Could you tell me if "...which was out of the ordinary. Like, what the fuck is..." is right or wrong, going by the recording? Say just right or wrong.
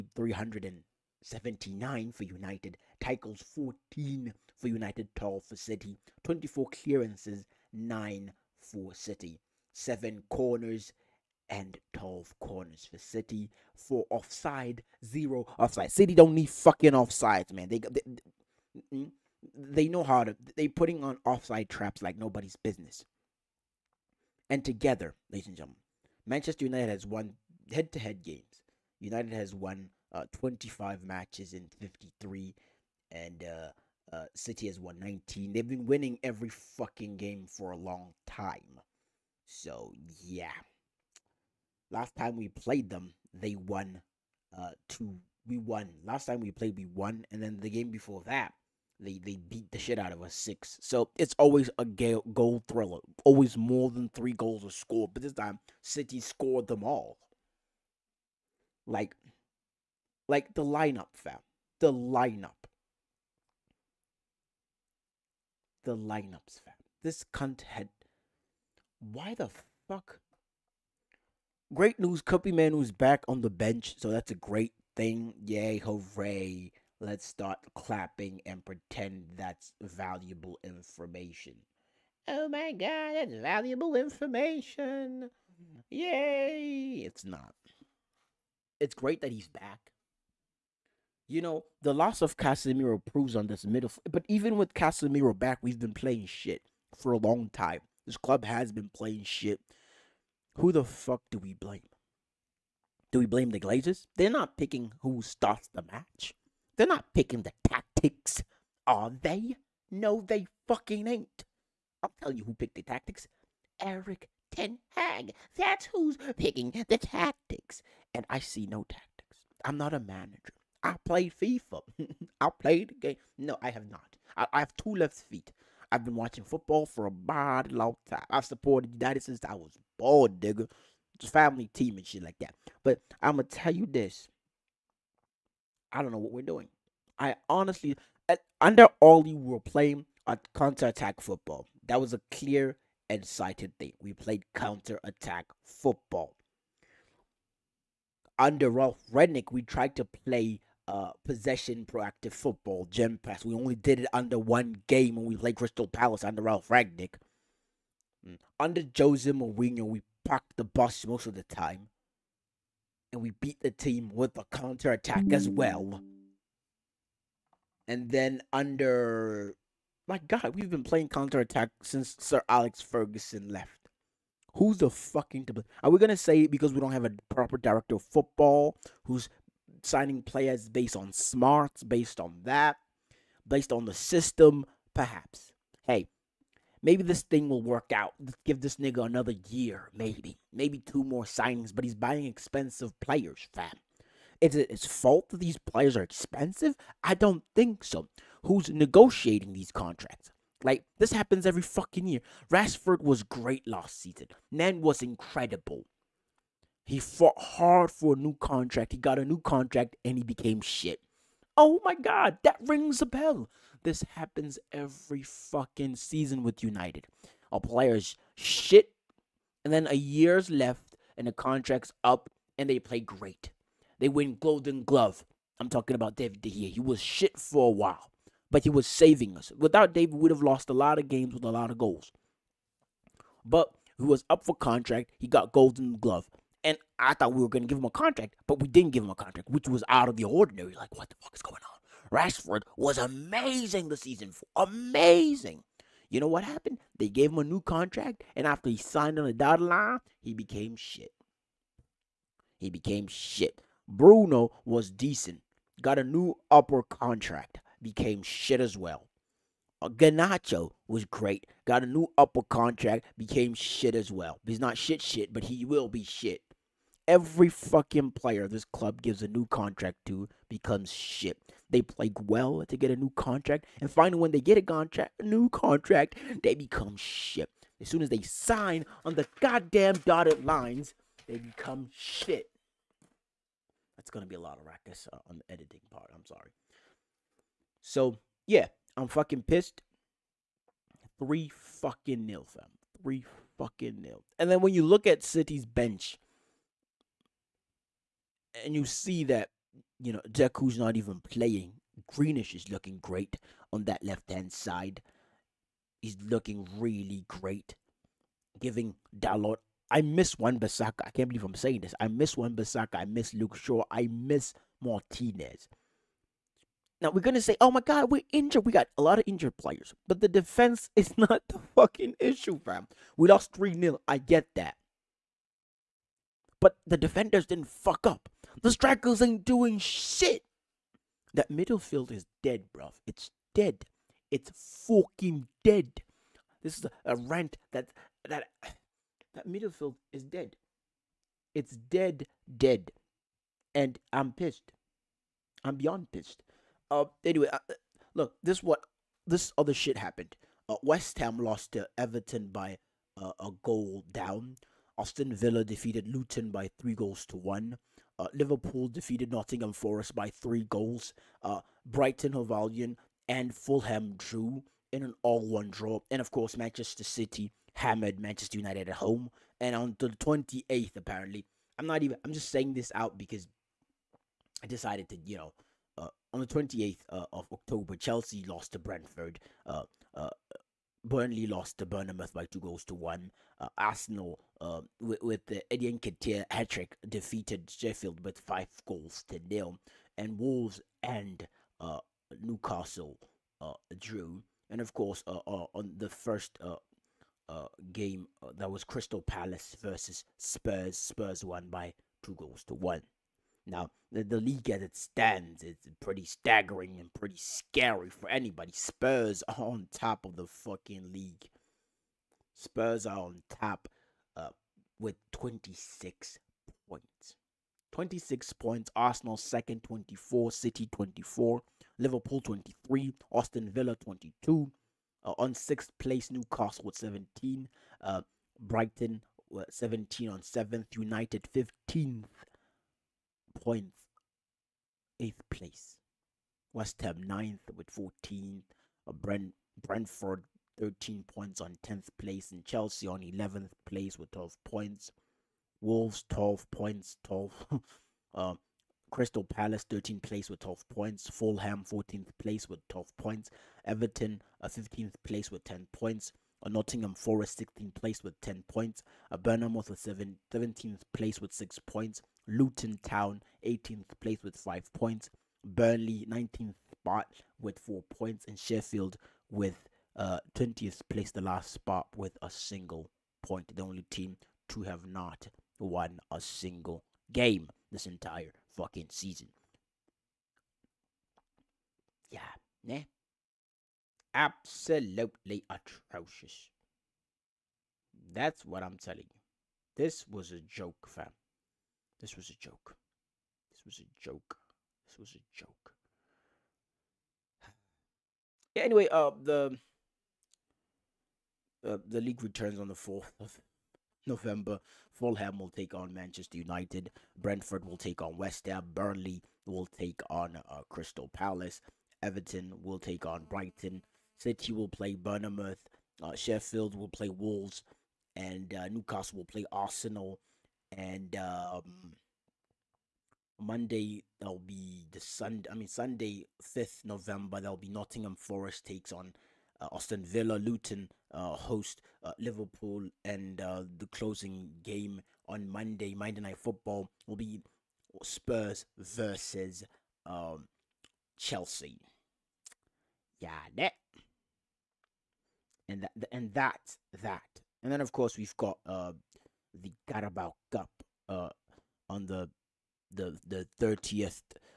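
right.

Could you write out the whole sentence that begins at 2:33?
We only did it under one game when we played Crystal Palace under Ralf Rangnick.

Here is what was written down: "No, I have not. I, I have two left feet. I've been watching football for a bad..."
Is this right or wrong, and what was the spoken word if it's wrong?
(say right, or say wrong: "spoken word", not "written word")
right.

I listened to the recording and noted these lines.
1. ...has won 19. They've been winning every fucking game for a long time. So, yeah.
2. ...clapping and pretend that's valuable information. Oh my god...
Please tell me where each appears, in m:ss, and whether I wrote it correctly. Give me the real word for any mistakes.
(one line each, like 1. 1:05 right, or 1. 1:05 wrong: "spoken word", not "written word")
1. 0:34 right
2. 1:17 right.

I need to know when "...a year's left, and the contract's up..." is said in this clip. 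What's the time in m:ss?
3:39.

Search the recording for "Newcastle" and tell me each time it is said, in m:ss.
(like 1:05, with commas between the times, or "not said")
6:32, 7:06, 8:38.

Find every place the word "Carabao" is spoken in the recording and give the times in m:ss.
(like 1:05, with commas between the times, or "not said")
9:10.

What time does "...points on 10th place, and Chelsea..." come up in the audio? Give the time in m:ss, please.
7:21.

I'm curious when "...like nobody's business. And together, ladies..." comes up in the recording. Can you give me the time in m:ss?
0:22.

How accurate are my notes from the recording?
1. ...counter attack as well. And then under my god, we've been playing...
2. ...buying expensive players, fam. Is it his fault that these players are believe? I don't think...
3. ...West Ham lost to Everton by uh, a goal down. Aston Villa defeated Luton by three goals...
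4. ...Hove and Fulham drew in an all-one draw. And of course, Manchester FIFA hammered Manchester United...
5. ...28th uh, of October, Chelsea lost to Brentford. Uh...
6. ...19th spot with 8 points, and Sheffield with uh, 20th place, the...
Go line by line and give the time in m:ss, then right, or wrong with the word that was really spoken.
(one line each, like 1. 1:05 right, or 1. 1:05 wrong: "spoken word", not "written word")
1. 2:44 right
2. 3:11 wrong: "expensive", not "believe"
3. 5:50 right
4. 6:02 wrong: "City", not "FIFA"
5. 6:16 right
6. 7:46 wrong: "4", not "8".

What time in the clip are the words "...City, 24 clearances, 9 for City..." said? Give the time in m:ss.
0:05.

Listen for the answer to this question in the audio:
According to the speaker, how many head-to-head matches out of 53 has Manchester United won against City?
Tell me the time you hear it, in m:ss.
0:30.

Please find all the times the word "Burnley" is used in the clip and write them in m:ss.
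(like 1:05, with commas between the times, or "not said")
6:21, 7:45, 8:28.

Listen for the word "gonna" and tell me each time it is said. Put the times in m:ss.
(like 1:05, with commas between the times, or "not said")
2:13, 2:55, 4:44, 5:17.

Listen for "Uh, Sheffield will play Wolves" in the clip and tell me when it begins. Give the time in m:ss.
8:36.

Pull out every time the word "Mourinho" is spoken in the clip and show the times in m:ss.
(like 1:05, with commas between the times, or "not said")
2:39.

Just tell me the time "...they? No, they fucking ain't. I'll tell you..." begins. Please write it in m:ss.
1:49.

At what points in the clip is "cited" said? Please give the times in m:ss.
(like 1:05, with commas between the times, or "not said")
2:23.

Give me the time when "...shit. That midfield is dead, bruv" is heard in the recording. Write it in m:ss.
5:29.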